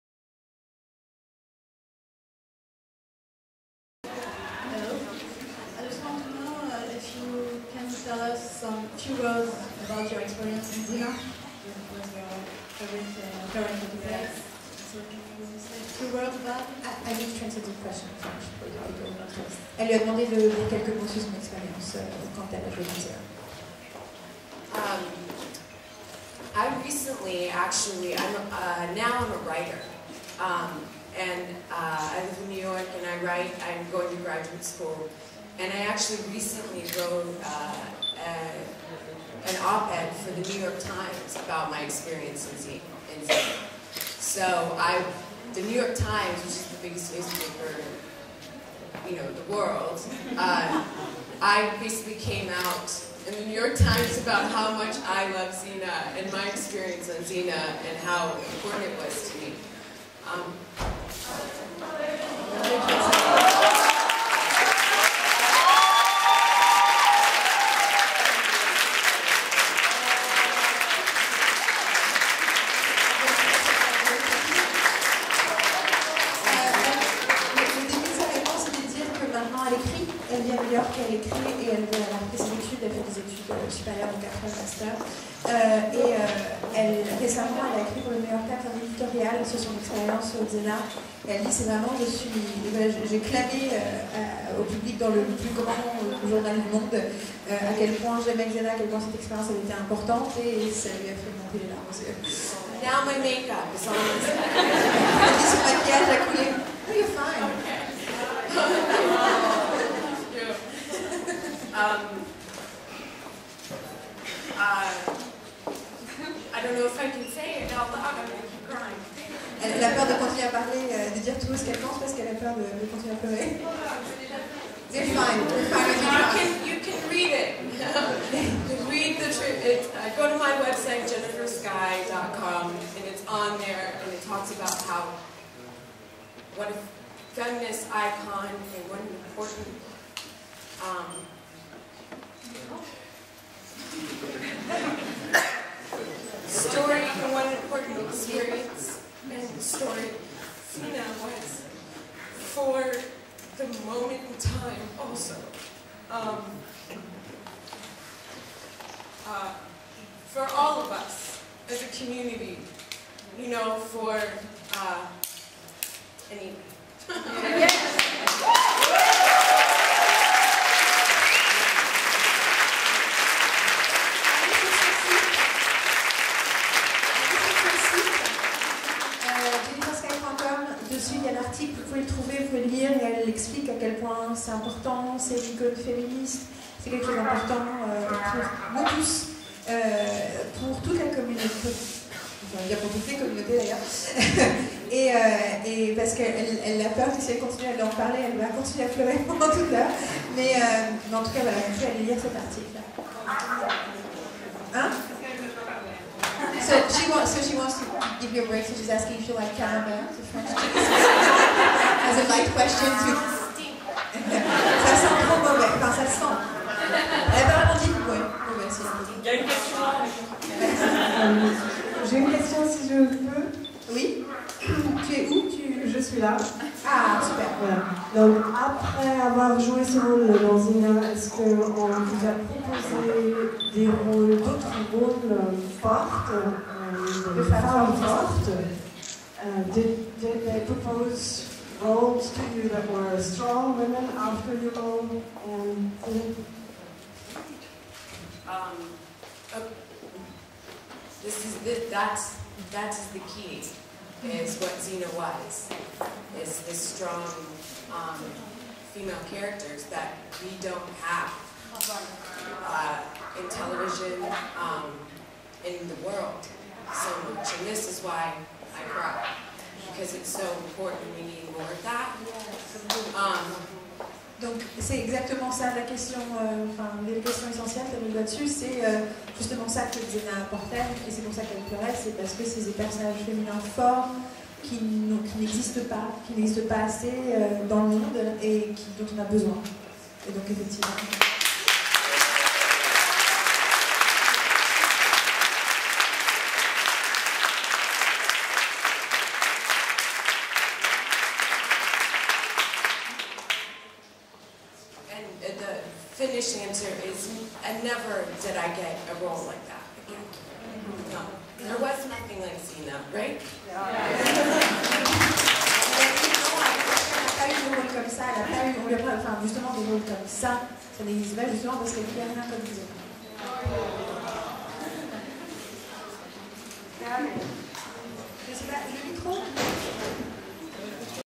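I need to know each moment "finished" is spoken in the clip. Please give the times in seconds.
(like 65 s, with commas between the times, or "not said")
306 s.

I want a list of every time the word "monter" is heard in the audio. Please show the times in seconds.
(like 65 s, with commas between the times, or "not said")
101 s.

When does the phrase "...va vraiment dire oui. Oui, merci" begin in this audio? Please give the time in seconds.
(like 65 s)
217 s.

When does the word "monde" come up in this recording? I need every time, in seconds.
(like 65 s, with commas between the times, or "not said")
96 s, 287 s.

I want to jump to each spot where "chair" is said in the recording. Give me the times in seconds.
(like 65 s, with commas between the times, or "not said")
not said.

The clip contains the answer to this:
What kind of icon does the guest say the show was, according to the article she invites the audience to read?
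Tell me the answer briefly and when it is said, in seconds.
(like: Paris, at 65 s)
feminist icon, at 137 s.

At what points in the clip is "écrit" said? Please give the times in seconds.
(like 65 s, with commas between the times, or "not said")
81 s, 87 s.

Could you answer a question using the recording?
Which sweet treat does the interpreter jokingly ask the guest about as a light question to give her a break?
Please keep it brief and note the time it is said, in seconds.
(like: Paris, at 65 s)
caramel, at 209 s.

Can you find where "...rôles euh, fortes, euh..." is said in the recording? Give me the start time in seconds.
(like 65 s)
234 s.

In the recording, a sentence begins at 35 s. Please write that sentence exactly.
And I actually recently wrote uh, a an op-ed for the New York Times about my experience in Xena.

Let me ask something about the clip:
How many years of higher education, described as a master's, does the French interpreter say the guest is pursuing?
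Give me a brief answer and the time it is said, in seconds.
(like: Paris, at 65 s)
4, at 84 s.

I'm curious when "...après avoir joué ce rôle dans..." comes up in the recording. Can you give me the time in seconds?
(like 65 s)
228 s.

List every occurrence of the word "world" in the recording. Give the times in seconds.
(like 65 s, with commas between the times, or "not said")
49 s, 266 s.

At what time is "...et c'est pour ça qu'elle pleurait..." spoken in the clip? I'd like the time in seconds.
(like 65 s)
281 s.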